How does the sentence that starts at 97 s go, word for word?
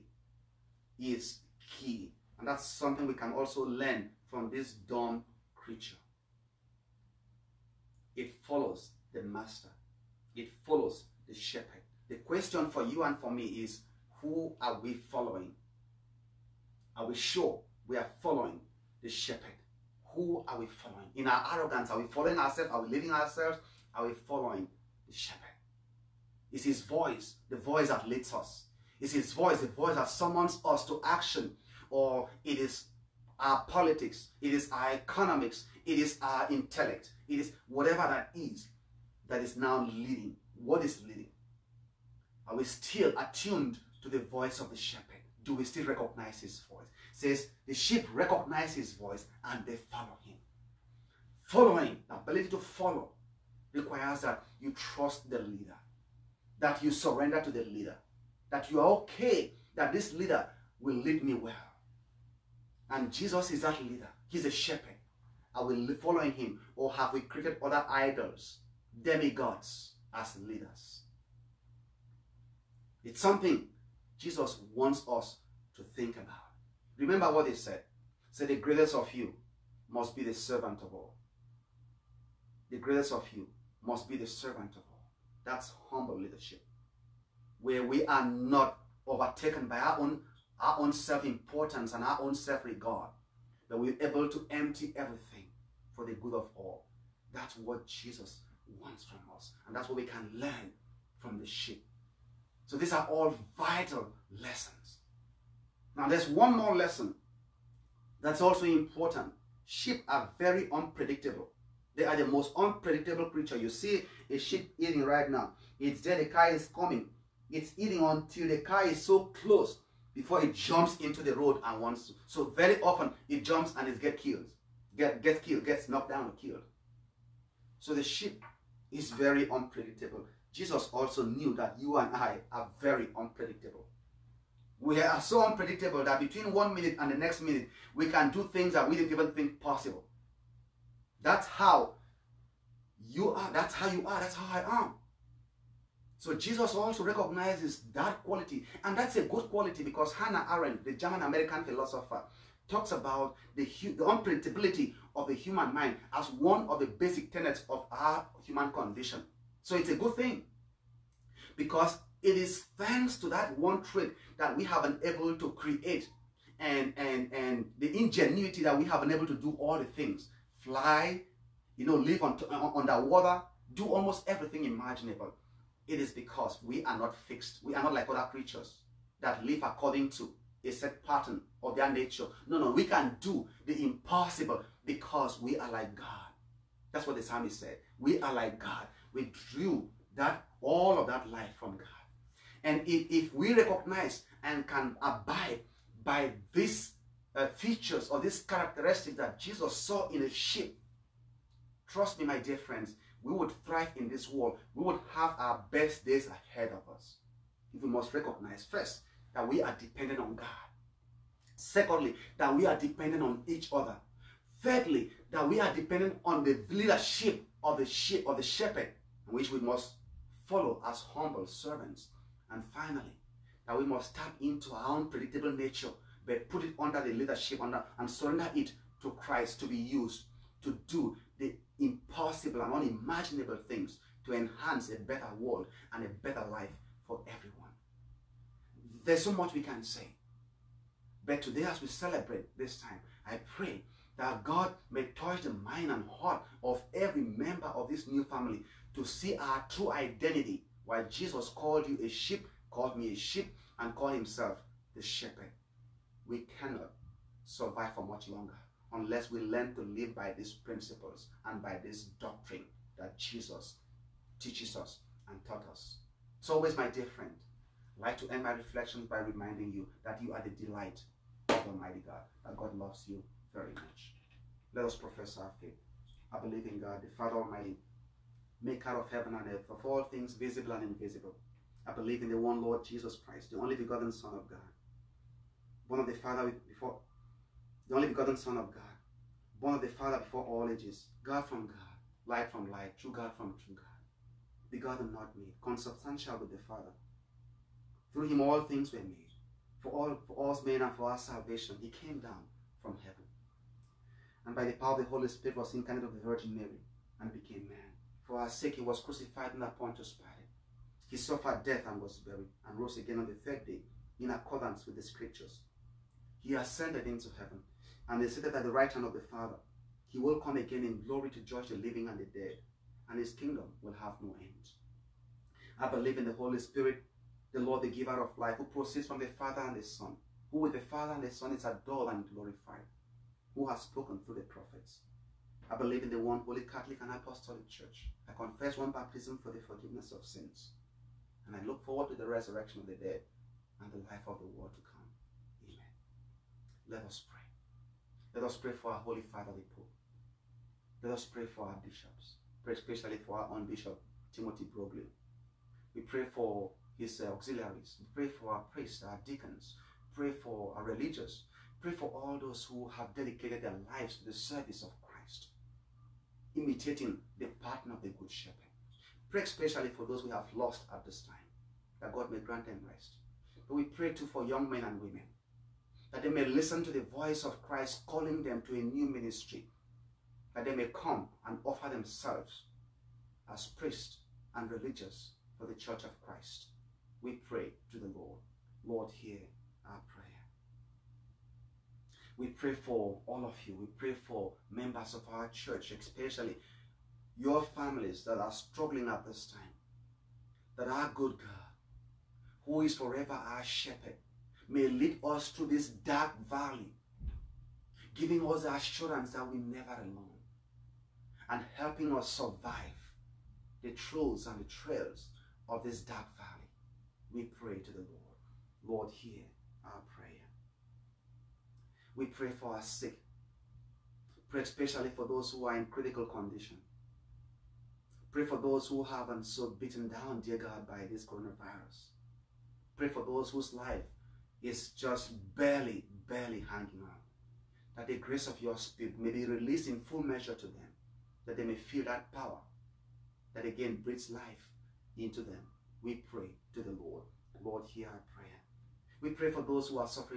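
That's what Jesus wants from us.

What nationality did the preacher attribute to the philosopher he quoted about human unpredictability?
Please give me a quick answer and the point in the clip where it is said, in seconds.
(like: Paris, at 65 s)
German-American, at 150 s.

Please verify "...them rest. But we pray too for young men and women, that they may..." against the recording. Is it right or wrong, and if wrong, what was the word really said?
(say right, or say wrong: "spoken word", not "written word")
right.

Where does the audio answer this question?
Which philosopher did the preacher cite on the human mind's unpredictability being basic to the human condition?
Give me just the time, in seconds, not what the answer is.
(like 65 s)
150 s.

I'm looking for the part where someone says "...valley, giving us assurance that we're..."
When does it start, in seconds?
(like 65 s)
406 s.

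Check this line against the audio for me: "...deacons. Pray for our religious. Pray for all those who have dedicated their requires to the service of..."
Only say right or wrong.
wrong.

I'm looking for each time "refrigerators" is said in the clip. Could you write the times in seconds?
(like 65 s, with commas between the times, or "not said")
not said.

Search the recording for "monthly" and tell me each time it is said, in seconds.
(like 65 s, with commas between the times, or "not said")
not said.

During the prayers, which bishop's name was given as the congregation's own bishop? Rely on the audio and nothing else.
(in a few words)
Timothy Broglio.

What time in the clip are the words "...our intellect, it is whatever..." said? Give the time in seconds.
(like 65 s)
36 s.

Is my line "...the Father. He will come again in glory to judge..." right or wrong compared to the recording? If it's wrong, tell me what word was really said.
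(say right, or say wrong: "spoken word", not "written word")
right.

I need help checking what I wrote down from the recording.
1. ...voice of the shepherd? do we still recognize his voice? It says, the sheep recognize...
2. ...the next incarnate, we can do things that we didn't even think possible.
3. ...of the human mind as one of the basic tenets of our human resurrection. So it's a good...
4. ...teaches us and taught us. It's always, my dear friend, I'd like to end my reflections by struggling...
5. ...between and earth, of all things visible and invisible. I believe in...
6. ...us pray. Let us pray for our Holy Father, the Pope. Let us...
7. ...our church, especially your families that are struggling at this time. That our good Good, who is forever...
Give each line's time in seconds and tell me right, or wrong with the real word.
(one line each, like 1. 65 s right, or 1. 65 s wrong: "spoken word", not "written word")
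1. 44 s right
2. 137 s wrong: "minute", not "incarnate"
3. 155 s wrong: "condition", not "resurrection"
4. 264 s wrong: "reminding", not "struggling"
5. 279 s wrong: "heaven", not "between"
6. 347 s right
7. 395 s wrong: "God", not "Good".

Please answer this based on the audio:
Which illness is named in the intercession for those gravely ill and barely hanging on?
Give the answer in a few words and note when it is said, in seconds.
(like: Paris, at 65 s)
coronavirus, at 431 s.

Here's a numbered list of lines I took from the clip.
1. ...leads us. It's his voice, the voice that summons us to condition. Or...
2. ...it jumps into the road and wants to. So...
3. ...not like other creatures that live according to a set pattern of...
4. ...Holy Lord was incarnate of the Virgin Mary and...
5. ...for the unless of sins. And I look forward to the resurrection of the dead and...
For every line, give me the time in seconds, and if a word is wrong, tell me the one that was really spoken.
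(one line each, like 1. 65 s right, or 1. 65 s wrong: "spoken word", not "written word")
1. 28 s wrong: "action", not "condition"
2. 120 s right
3. 177 s right
4. 305 s wrong: "Spirit", not "Lord"
5. 339 s wrong: "forgiveness", not "unless".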